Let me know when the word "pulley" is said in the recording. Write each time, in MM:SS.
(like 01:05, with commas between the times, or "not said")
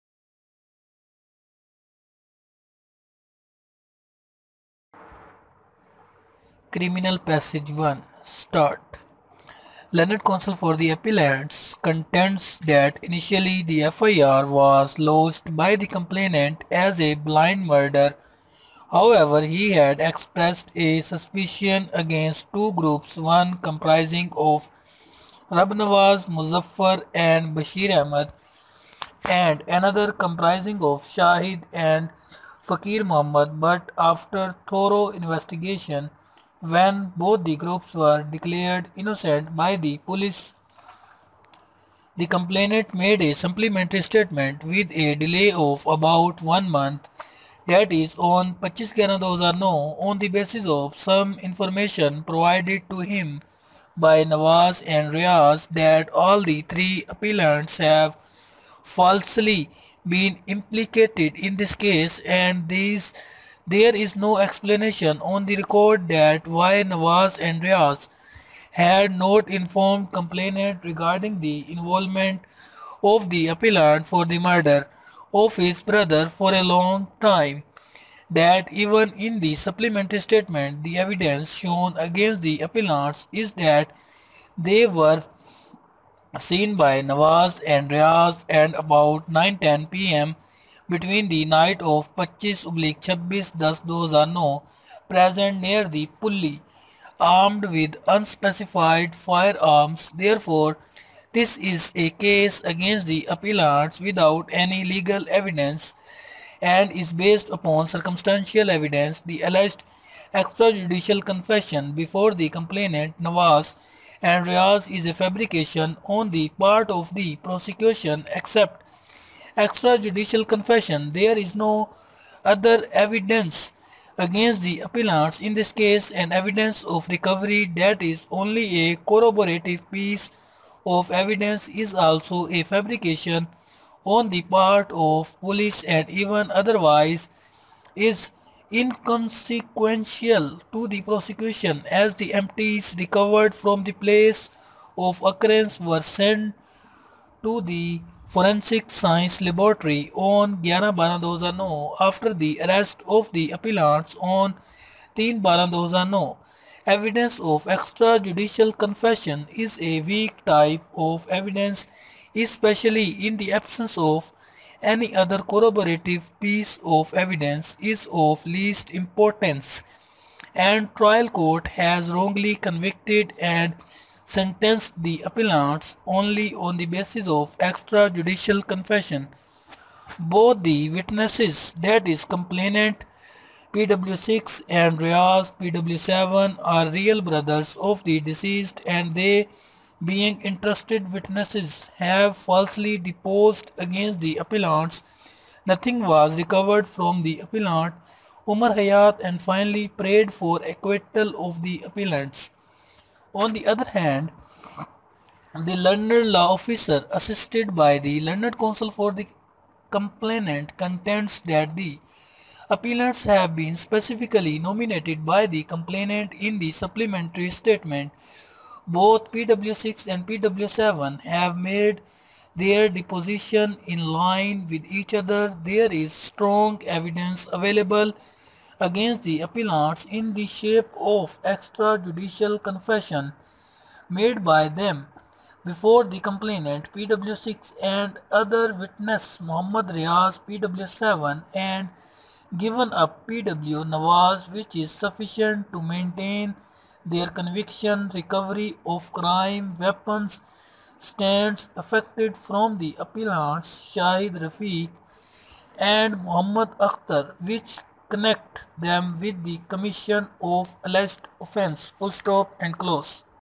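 01:36.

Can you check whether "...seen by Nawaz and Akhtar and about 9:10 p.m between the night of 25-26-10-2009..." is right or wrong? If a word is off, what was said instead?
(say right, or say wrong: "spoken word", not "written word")
wrong: "Riaz", not "Akhtar".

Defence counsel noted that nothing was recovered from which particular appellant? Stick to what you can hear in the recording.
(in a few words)
Umar Hayat.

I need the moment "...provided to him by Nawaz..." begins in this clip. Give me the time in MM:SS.
00:52.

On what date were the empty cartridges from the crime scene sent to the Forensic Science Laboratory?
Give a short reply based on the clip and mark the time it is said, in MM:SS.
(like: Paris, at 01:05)
11-12-2009, at 02:30.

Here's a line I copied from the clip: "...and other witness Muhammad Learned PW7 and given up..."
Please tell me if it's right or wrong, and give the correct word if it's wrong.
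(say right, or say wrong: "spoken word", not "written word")
wrong: "Riaz", not "Learned".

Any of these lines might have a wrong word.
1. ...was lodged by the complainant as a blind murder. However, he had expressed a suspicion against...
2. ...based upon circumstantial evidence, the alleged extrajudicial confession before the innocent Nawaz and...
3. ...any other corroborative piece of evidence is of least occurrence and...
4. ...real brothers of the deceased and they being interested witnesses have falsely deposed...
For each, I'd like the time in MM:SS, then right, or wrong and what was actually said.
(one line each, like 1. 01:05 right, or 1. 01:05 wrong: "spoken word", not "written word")
1. 00:14 right
2. 01:47 wrong: "complainant", not "innocent"
3. 02:44 wrong: "importance", not "occurrence"
4. 03:06 right.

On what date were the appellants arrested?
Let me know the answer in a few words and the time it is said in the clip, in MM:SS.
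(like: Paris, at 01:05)
3-12-2009, at 02:35.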